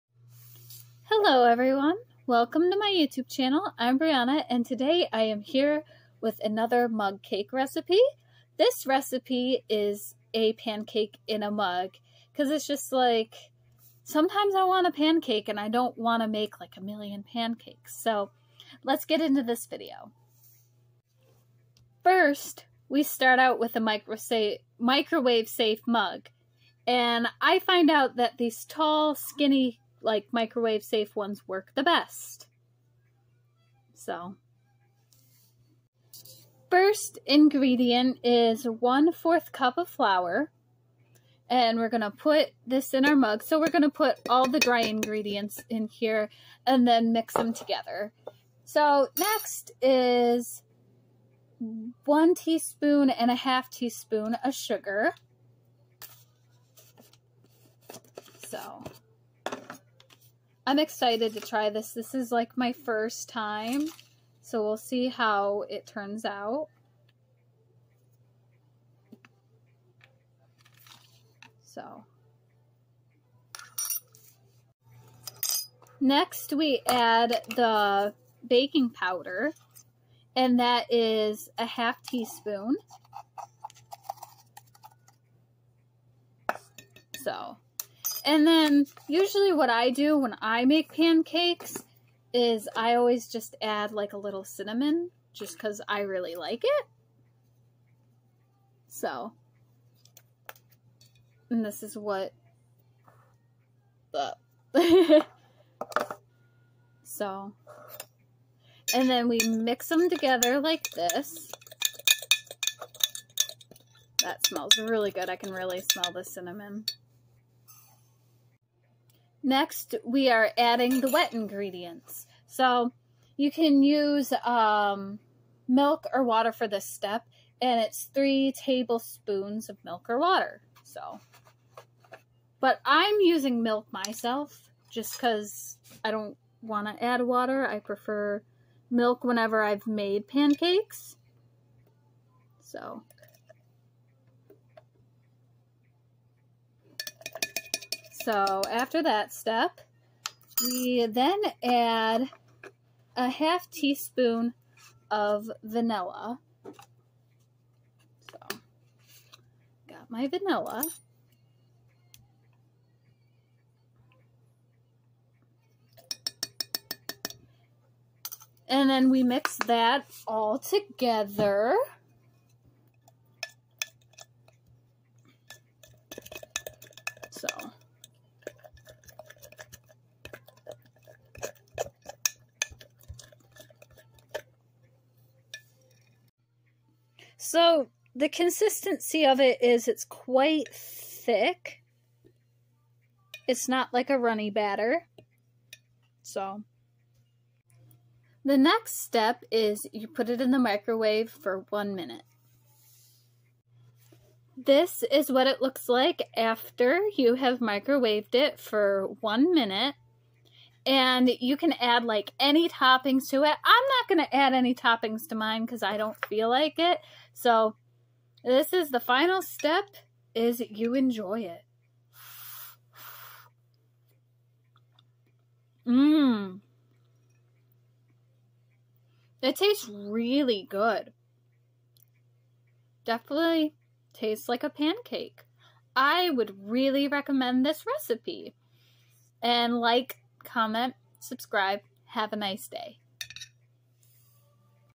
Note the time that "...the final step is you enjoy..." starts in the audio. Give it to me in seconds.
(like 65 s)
218 s.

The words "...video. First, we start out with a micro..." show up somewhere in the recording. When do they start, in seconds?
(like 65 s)
19 s.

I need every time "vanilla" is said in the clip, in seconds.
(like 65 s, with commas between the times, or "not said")
155 s, 160 s.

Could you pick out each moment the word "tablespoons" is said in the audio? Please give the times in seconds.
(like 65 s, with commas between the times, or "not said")
128 s.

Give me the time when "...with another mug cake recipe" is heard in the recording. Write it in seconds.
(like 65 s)
6 s.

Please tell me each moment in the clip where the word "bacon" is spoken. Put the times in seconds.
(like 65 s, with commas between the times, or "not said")
not said.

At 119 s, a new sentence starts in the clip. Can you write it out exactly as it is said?
Next, we are adding the wet ingredients.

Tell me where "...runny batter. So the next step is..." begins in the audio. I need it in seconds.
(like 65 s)
194 s.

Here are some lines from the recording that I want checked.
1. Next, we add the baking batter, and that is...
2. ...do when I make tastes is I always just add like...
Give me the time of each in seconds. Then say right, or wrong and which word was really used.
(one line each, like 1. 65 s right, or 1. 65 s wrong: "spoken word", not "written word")
1. 75 s wrong: "powder", not "batter"
2. 89 s wrong: "pancakes", not "tastes".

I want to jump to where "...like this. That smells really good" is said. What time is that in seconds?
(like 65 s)
110 s.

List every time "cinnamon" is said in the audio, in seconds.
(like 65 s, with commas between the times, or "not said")
94 s, 116 s.